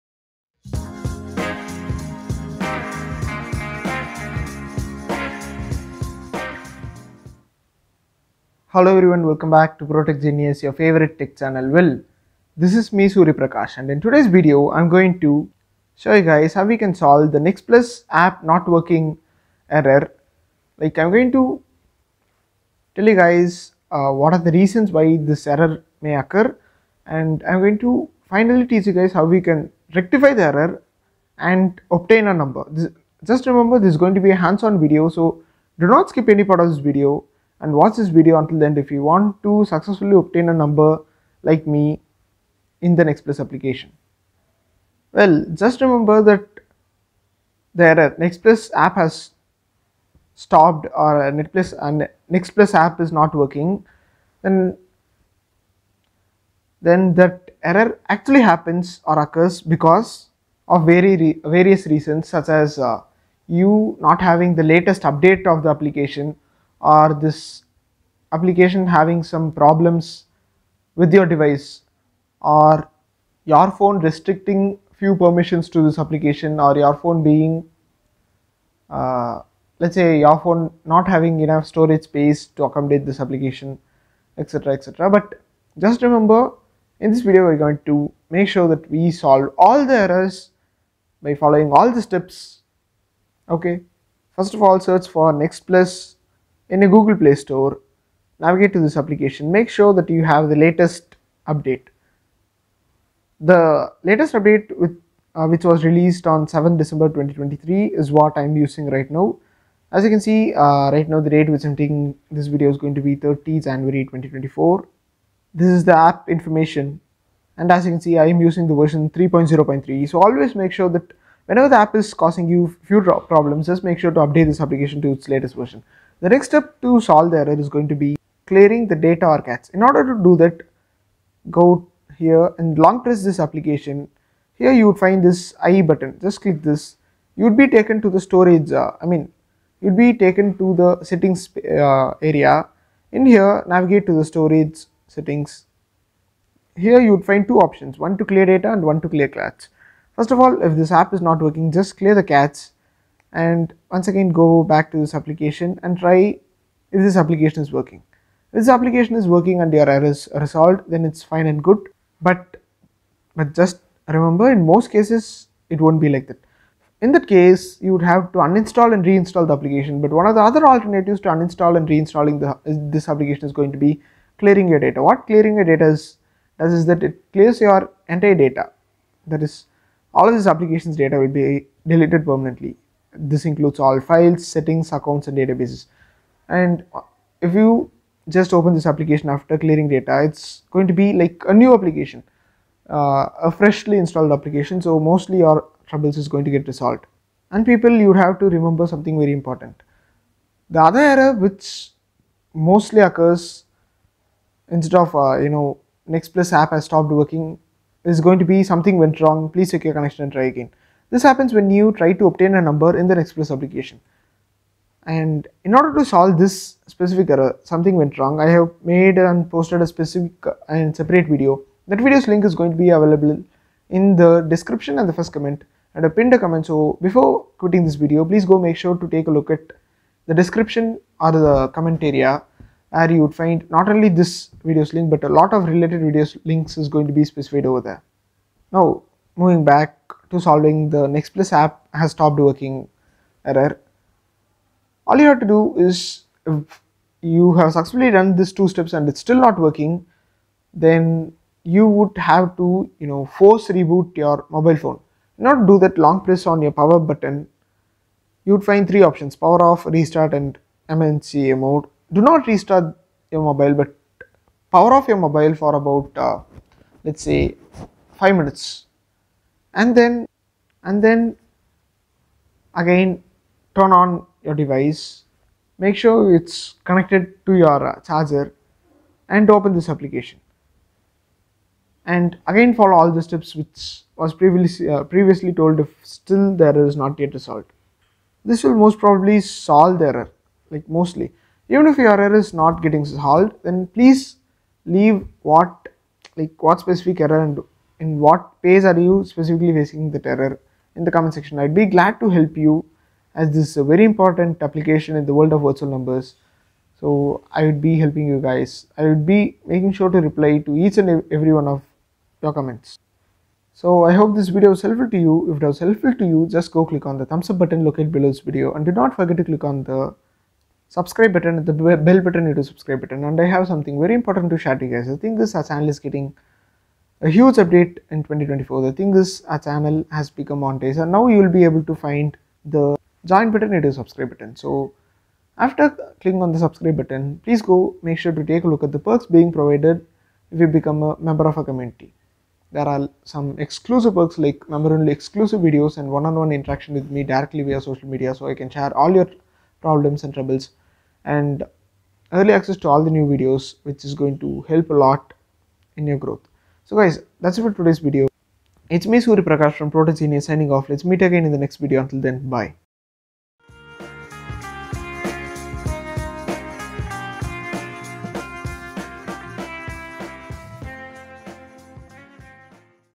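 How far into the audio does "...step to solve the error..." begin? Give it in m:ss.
2:06.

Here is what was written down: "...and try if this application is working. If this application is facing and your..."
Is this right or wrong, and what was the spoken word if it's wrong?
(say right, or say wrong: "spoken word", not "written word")
wrong: "working", not "facing".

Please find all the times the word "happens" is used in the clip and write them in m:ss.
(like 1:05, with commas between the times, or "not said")
0:58, 3:31.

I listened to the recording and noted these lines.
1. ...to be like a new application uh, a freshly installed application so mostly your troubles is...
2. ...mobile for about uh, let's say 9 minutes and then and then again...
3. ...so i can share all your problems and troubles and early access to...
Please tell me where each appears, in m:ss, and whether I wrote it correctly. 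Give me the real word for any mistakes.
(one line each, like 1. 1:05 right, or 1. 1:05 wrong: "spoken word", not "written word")
1. 3:10 right
2. 4:25 wrong: "5", not "9"
3. 5:48 right.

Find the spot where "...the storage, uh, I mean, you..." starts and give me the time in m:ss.
2:18.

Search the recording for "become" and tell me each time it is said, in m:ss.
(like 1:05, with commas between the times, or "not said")
5:30, 5:40.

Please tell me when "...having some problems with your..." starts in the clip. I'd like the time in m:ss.
1:08.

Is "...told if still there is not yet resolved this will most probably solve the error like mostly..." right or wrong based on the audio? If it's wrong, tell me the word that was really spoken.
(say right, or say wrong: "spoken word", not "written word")
right.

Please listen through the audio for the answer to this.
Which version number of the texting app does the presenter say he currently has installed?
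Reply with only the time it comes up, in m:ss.
1:59.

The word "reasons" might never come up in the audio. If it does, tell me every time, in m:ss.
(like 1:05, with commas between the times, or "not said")
0:24, 1:01.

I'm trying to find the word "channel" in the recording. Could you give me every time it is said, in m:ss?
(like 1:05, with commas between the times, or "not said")
0:11, 5:25, 5:29.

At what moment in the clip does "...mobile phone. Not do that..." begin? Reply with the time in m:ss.
4:14.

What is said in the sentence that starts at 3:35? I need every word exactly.
And in order to solve this specific error, something went wrong.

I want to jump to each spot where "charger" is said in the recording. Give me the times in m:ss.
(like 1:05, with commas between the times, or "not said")
4:38.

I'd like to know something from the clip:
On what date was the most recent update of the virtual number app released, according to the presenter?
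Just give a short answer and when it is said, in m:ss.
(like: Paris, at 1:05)
7 December 2023, at 1:46.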